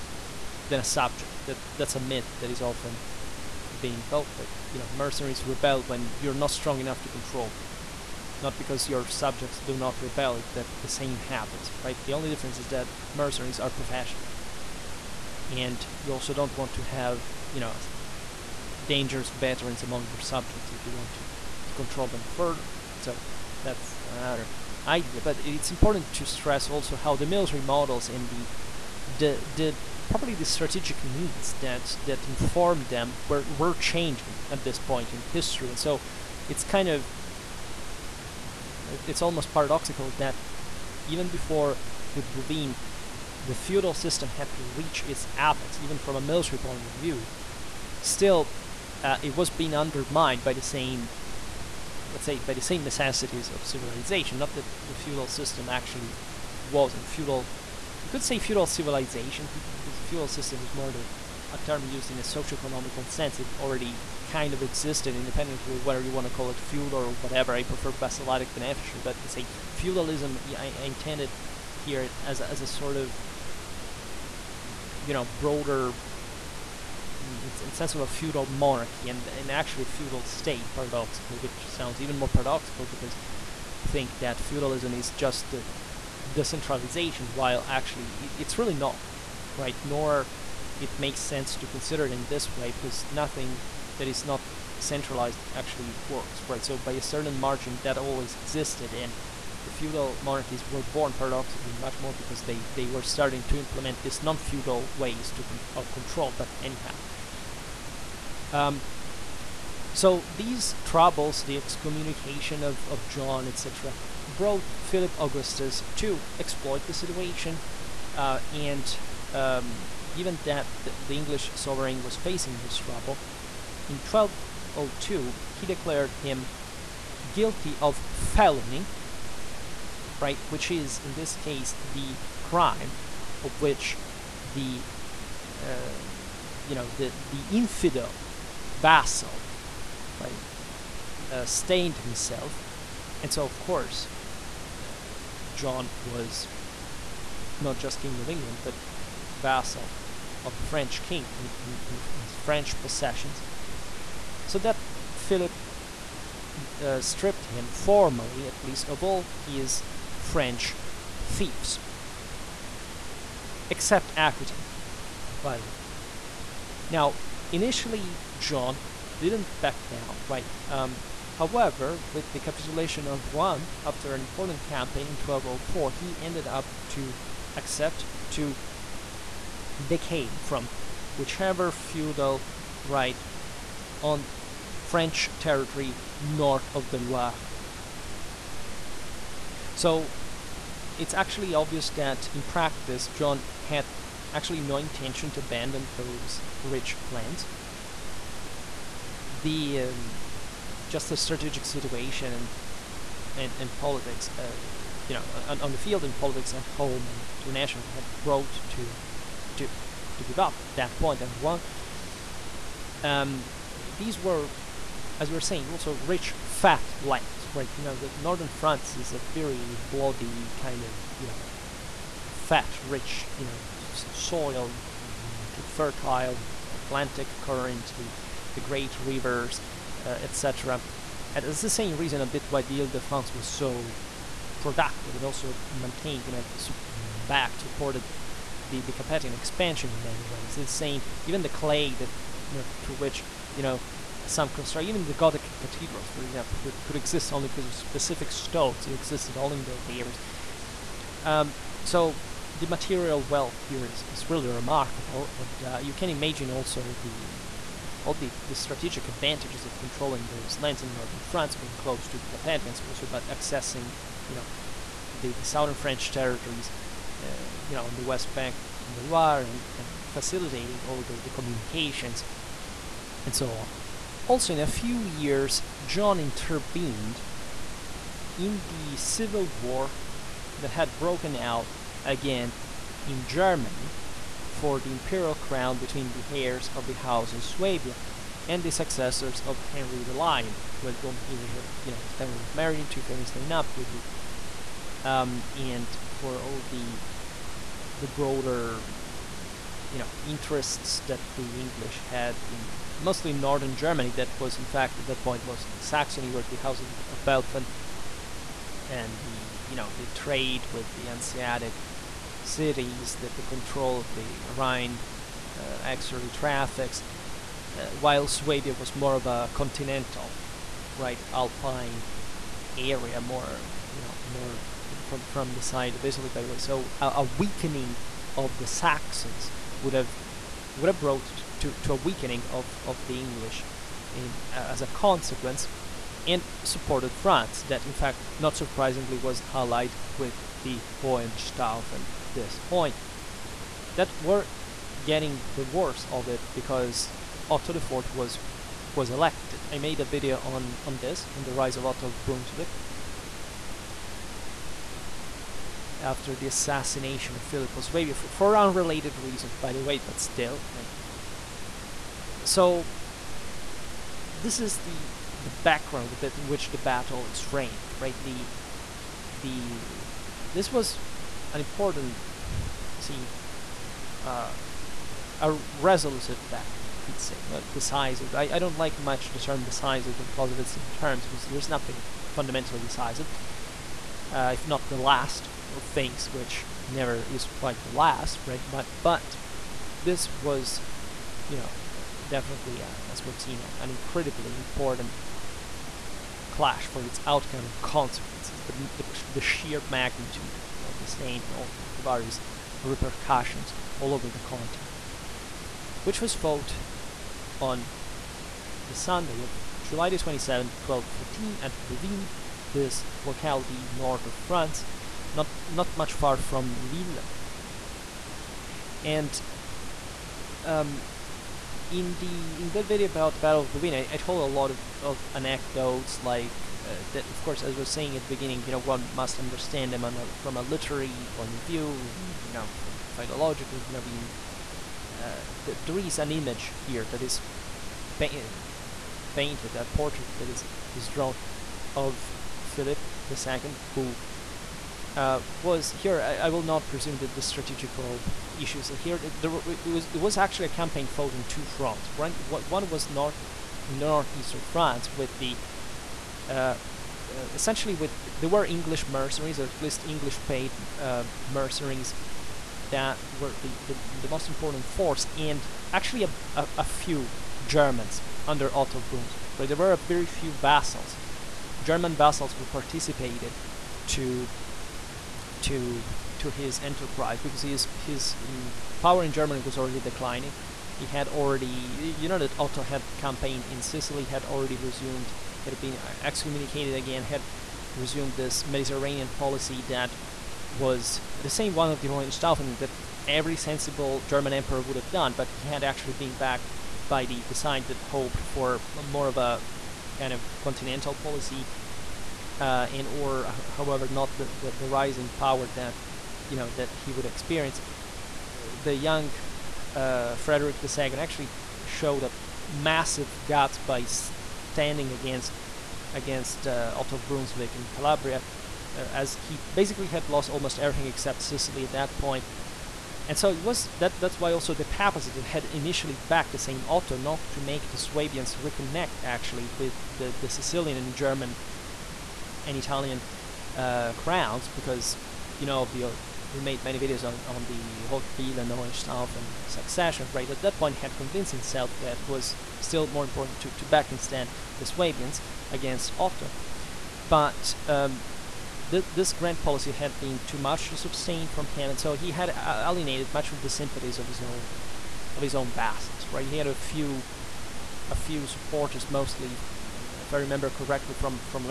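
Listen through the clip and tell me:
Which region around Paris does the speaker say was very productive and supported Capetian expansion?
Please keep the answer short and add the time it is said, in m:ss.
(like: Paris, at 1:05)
Ile de France, at 3:52.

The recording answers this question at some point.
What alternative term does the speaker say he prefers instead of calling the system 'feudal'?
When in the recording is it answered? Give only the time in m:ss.
1:07.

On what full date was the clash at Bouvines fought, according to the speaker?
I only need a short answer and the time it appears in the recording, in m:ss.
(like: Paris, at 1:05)
July 27, 1214, at 6:49.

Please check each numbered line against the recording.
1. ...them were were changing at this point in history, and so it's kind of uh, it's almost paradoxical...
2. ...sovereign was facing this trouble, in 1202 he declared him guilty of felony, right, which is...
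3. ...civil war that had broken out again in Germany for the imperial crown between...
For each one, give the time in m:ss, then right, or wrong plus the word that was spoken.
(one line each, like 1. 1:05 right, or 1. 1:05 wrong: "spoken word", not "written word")
1. 0:32 right
2. 2:01 right
3. 4:38 right.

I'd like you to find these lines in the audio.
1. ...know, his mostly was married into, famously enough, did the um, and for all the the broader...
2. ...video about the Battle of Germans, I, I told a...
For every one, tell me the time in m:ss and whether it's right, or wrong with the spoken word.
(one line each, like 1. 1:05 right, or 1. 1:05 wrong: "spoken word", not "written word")
1. 4:51 wrong: "family", not "mostly"
2. 7:02 wrong: "Bouvines", not "Germans".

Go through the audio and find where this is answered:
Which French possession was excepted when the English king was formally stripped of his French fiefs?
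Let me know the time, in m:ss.
2:44.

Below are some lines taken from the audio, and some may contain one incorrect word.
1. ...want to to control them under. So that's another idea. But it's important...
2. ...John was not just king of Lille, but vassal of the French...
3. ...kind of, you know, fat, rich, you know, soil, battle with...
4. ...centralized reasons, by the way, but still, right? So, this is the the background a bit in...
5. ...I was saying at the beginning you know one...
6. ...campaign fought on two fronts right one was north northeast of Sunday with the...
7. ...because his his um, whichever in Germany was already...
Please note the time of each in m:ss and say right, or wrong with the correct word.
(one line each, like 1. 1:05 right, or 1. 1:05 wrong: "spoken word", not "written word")
1. 0:20 wrong: "further", not "under"
2. 2:25 wrong: "England", not "Lille"
3. 3:40 wrong: "fertile", not "battle"
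4. 5:58 wrong: "unrelated", not "centralized"
5. 7:07 right
6. 7:30 wrong: "France", not "Sunday"
7. 7:57 wrong: "power", not "whichever".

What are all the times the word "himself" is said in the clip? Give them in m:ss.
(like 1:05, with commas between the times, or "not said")
2:21, 9:01.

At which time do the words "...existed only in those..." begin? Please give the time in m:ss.
4:08.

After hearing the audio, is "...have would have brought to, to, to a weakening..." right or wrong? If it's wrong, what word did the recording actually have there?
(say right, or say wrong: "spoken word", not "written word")
right.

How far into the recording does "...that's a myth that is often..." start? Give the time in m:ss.
0:01.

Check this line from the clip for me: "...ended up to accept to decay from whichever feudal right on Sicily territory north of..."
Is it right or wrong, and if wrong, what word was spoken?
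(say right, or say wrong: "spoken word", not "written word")
wrong: "French", not "Sicily".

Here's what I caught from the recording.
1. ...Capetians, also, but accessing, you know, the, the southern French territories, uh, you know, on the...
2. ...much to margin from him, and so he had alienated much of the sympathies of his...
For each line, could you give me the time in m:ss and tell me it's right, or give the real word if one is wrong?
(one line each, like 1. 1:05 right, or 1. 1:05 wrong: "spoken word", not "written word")
1. 4:22 right
2. 9:10 wrong: "sustain", not "margin".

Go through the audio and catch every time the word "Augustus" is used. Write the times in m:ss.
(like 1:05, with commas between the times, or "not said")
1:55.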